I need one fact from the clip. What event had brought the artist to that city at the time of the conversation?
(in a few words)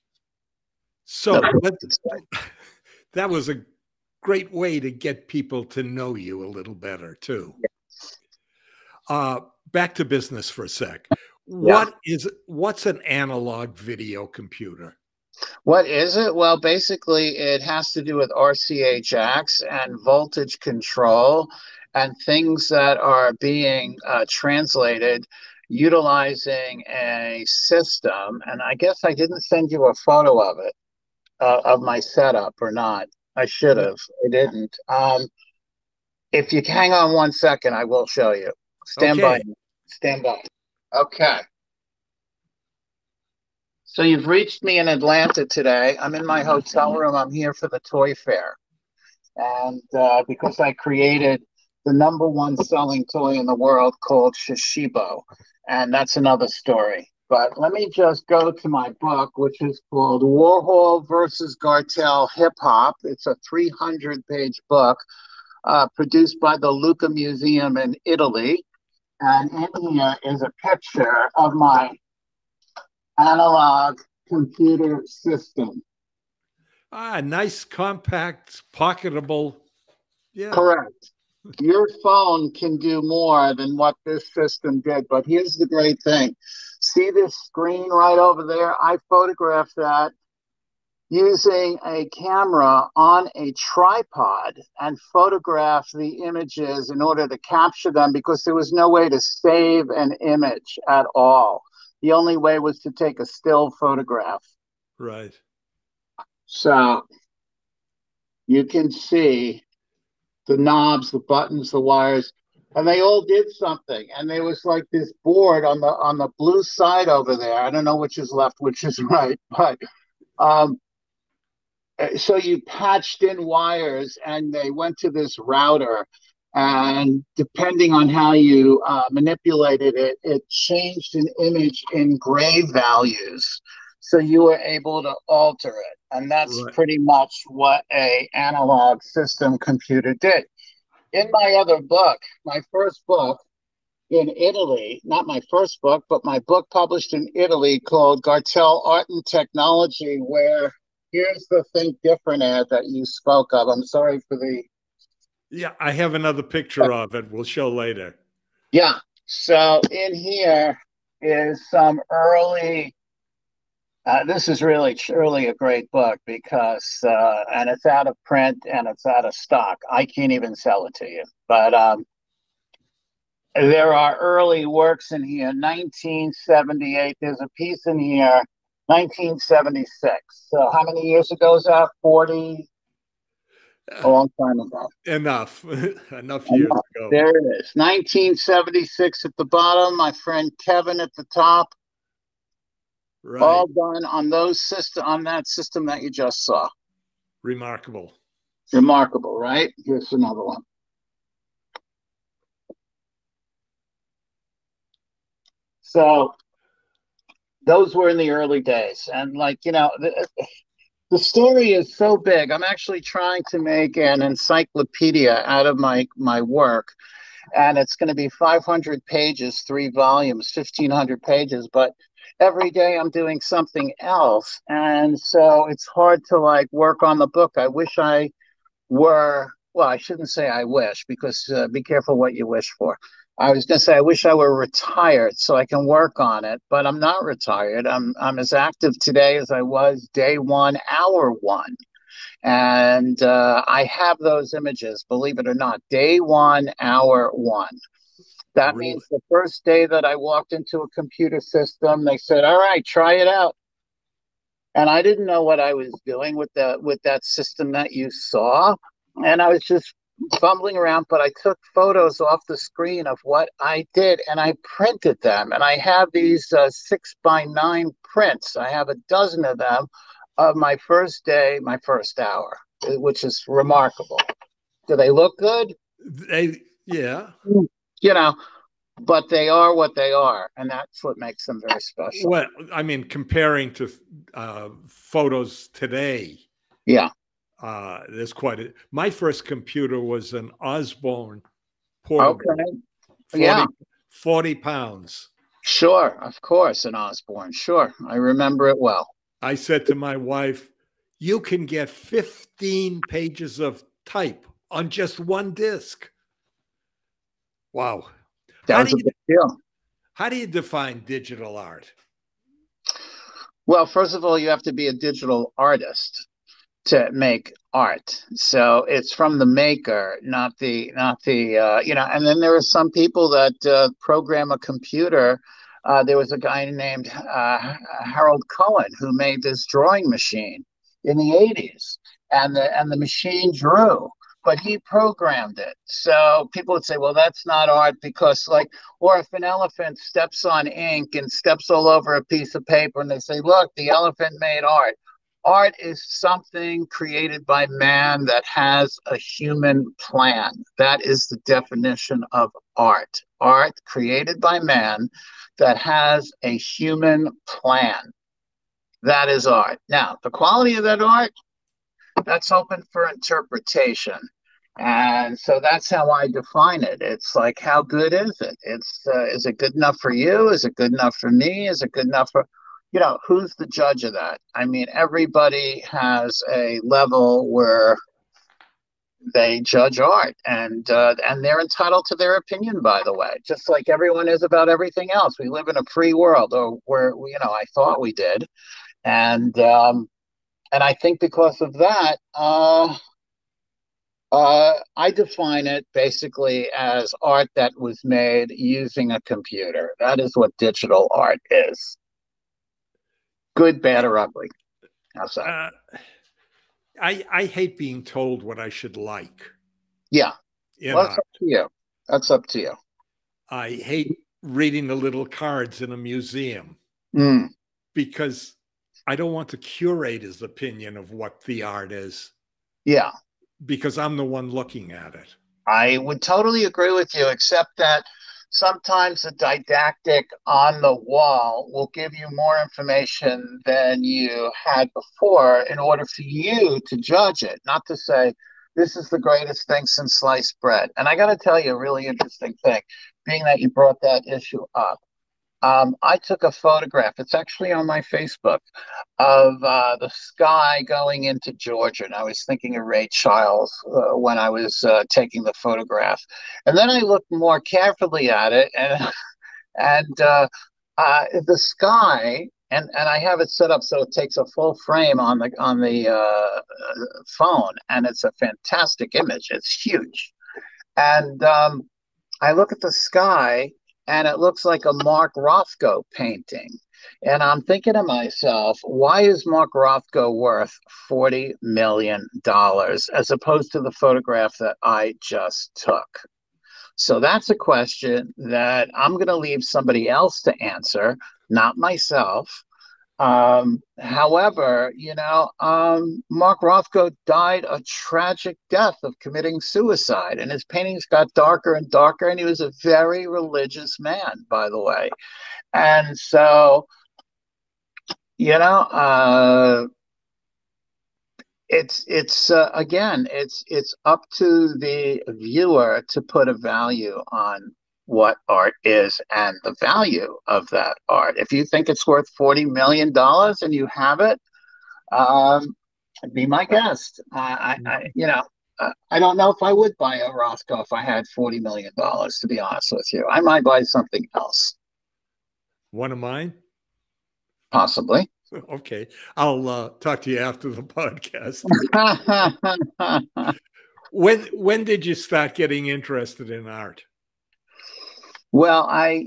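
the toy fair.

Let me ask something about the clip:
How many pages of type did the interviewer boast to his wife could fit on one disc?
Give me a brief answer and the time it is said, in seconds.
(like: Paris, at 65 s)
15, at 301 s.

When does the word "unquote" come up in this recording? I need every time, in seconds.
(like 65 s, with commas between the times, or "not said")
not said.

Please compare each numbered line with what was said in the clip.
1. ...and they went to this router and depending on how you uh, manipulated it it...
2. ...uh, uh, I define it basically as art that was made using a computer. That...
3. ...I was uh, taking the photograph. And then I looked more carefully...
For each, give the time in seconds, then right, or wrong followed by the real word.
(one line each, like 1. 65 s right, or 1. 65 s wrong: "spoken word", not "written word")
1. 124 s right
2. 392 s right
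3. 454 s right.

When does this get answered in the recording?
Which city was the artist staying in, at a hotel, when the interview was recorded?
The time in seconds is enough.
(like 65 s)
44 s.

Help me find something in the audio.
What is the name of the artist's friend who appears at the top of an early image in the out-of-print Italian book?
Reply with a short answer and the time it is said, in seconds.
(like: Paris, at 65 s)
Kevin, at 190 s.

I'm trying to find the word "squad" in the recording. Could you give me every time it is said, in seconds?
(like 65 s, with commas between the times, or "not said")
not said.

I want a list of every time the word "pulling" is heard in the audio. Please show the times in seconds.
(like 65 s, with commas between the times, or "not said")
not said.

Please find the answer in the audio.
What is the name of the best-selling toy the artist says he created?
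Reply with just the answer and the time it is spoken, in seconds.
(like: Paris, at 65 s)
Shishibo, at 54 s.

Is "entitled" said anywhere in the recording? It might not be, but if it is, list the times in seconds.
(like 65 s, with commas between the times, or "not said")
381 s.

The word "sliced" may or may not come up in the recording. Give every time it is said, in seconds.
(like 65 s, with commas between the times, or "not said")
440 s.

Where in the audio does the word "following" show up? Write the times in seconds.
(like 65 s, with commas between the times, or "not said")
not said.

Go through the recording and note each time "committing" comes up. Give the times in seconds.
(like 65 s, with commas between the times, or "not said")
499 s.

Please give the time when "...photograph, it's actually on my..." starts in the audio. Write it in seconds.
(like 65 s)
446 s.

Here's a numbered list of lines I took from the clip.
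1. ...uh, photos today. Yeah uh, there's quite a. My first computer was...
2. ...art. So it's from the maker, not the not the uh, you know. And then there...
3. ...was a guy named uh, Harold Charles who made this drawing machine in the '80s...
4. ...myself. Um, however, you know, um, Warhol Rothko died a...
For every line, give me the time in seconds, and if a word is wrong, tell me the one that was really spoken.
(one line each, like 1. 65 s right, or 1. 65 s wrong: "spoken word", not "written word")
1. 284 s right
2. 317 s right
3. 326 s wrong: "Cohen", not "Charles"
4. 491 s wrong: "Mark", not "Warhol".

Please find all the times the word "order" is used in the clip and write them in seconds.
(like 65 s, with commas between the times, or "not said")
97 s, 435 s.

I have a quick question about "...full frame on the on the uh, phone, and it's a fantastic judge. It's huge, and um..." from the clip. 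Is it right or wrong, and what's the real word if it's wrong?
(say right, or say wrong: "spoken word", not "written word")
wrong: "image", not "judge".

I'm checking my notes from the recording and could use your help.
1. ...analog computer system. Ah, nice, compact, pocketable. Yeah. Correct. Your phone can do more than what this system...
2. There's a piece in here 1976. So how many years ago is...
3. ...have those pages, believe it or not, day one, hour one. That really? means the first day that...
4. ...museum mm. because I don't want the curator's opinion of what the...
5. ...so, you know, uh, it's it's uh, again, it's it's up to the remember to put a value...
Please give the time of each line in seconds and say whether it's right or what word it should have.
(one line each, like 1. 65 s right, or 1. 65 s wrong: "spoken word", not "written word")
1. 73 s right
2. 177 s right
3. 243 s wrong: "images", not "pages"
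4. 415 s right
5. 506 s wrong: "viewer", not "remember".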